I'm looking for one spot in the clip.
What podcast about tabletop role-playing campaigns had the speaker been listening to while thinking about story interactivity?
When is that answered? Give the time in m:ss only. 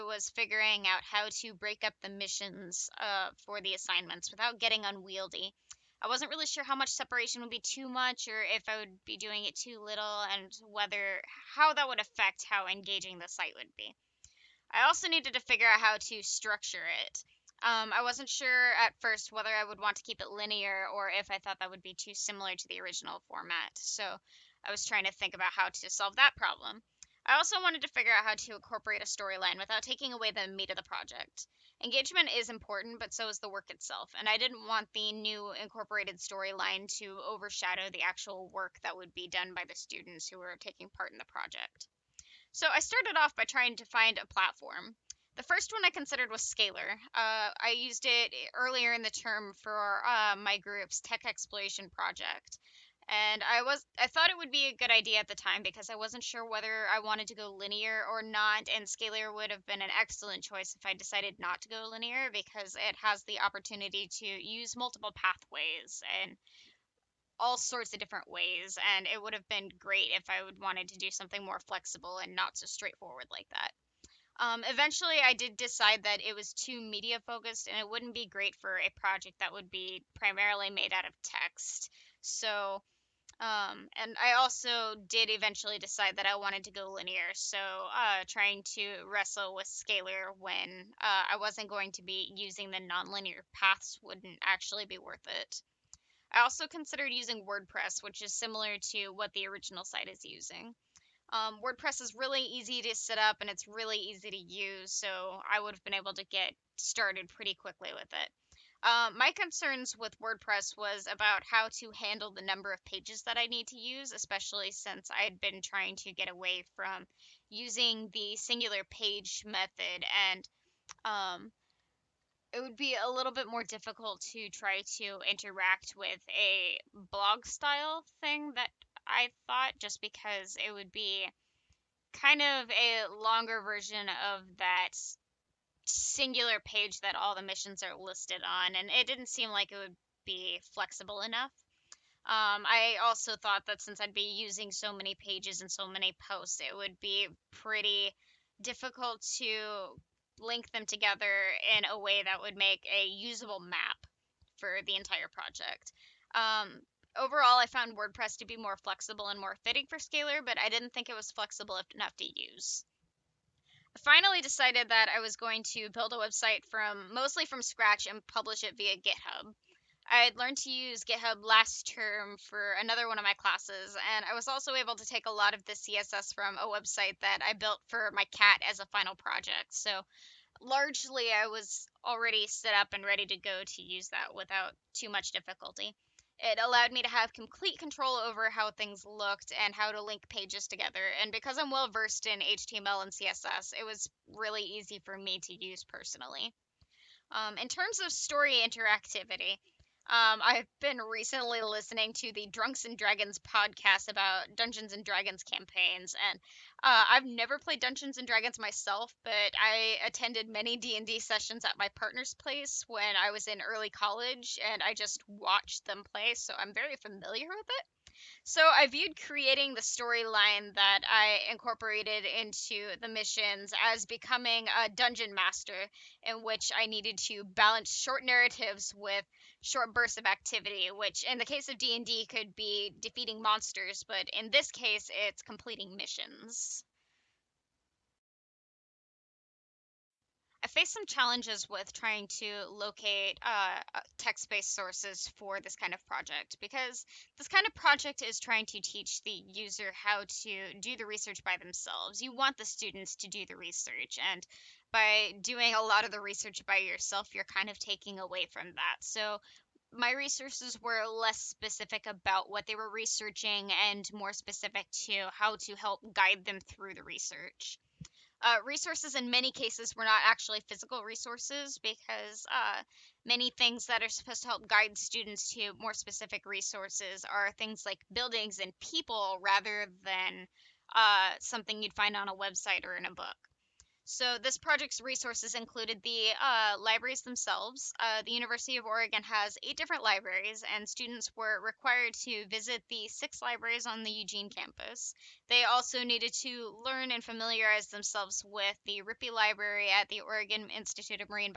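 3:22.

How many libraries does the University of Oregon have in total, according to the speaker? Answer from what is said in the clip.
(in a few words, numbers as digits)
8.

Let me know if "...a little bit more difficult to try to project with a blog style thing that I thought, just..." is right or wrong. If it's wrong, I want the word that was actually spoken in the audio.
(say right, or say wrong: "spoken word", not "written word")
wrong: "interact", not "project".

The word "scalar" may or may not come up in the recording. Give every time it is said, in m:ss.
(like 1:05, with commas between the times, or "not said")
0:46, 0:58, 1:29, 2:39.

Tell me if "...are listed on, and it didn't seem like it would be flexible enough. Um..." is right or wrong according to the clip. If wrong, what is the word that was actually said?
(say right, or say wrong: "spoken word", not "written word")
right.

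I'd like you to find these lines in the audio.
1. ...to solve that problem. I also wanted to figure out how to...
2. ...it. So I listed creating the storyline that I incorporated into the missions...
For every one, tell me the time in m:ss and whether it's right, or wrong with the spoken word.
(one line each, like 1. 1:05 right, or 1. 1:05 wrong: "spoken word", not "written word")
1. 0:25 right
2. 3:37 wrong: "viewed", not "listed".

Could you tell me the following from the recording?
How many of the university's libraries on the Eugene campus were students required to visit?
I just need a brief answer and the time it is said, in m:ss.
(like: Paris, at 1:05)
6, at 4:53.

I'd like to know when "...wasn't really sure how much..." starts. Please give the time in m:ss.
0:06.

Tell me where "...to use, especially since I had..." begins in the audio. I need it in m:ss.
1:53.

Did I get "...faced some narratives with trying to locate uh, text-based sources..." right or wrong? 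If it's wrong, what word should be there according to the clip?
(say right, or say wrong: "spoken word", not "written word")
wrong: "challenges", not "narratives".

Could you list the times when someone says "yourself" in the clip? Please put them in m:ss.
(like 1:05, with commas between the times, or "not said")
4:16.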